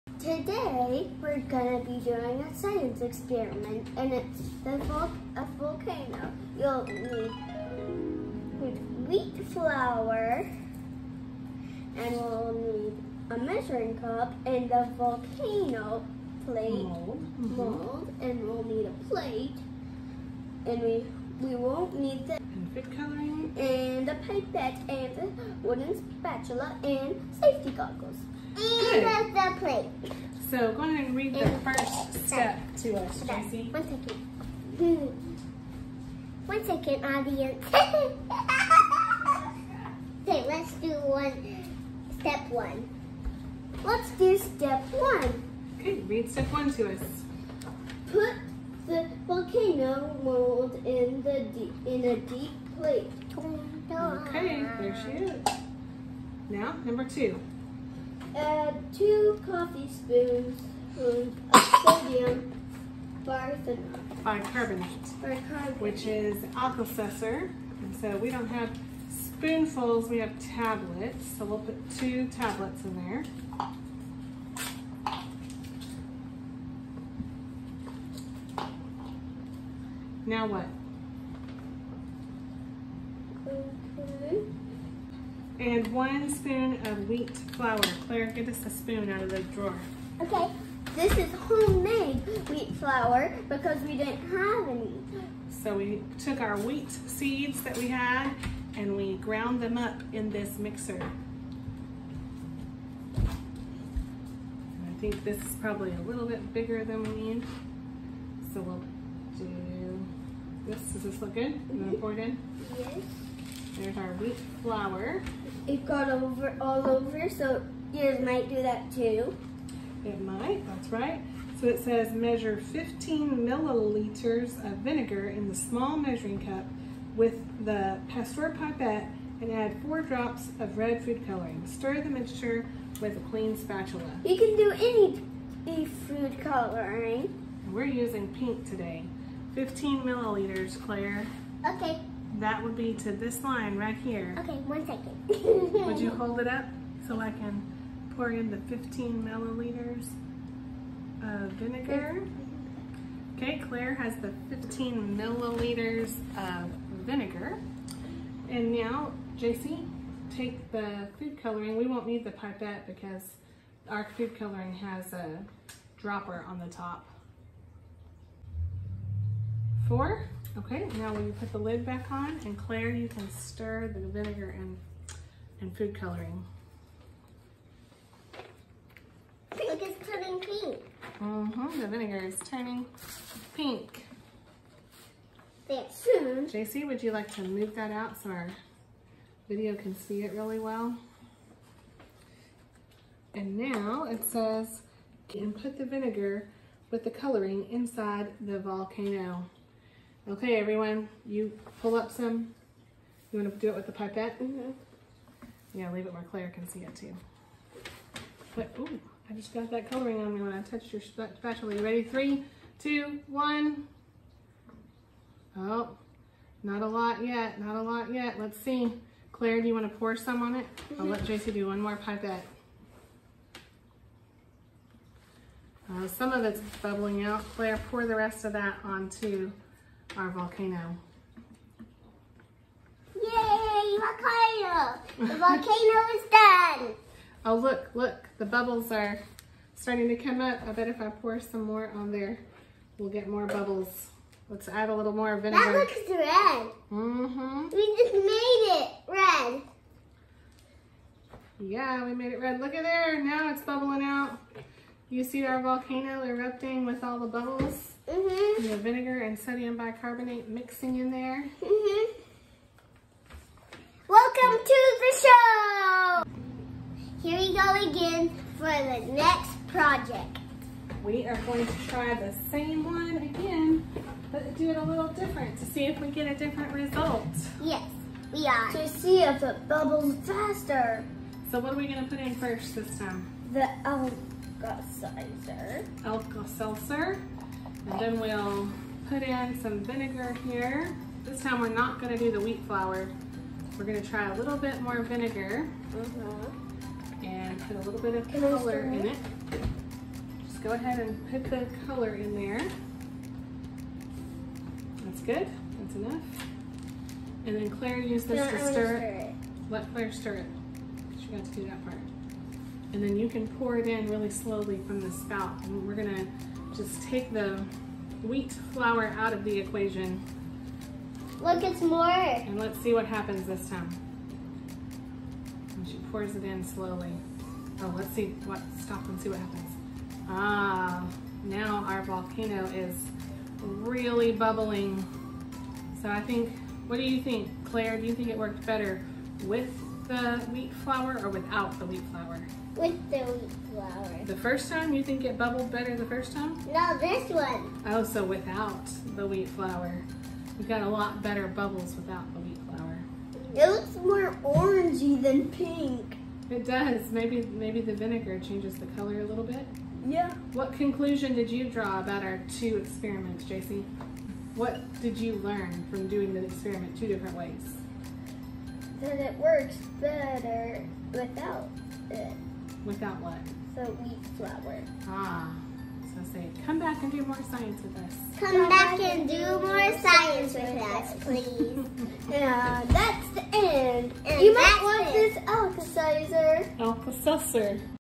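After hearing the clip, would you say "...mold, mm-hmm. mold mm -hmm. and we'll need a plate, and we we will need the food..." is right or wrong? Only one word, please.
right.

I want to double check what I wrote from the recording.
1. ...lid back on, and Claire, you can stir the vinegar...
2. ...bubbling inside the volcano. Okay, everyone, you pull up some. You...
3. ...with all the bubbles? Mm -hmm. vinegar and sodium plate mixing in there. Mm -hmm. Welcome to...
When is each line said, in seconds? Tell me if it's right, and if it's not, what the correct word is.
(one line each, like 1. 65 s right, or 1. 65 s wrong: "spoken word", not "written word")
1. 171 s right
2. 197 s wrong: "coloring", not "bubbling"
3. 256 s wrong: "bicarbonate", not "plate".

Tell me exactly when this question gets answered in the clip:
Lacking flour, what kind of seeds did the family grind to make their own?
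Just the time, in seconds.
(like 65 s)
96 s.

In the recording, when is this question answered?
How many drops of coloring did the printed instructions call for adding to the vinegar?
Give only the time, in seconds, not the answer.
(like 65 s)
129 s.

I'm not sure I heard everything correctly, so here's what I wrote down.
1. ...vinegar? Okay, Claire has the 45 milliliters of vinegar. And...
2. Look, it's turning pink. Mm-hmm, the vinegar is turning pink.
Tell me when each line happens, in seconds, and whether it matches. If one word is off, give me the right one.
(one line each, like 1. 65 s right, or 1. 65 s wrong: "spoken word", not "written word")
1. 151 s wrong: "15", not "45"
2. 179 s right.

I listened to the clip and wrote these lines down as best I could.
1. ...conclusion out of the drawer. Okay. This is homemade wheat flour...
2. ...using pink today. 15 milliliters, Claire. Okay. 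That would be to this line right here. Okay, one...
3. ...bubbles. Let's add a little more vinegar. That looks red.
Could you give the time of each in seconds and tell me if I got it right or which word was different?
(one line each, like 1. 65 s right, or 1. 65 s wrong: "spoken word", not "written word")
1. 88 s wrong: "spoon", not "conclusion"
2. 137 s right
3. 243 s right.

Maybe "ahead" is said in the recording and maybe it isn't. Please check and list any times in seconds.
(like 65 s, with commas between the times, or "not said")
30 s, 300 s.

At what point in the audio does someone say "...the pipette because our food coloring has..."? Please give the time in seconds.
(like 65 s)
162 s.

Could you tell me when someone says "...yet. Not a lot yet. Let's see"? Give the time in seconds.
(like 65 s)
217 s.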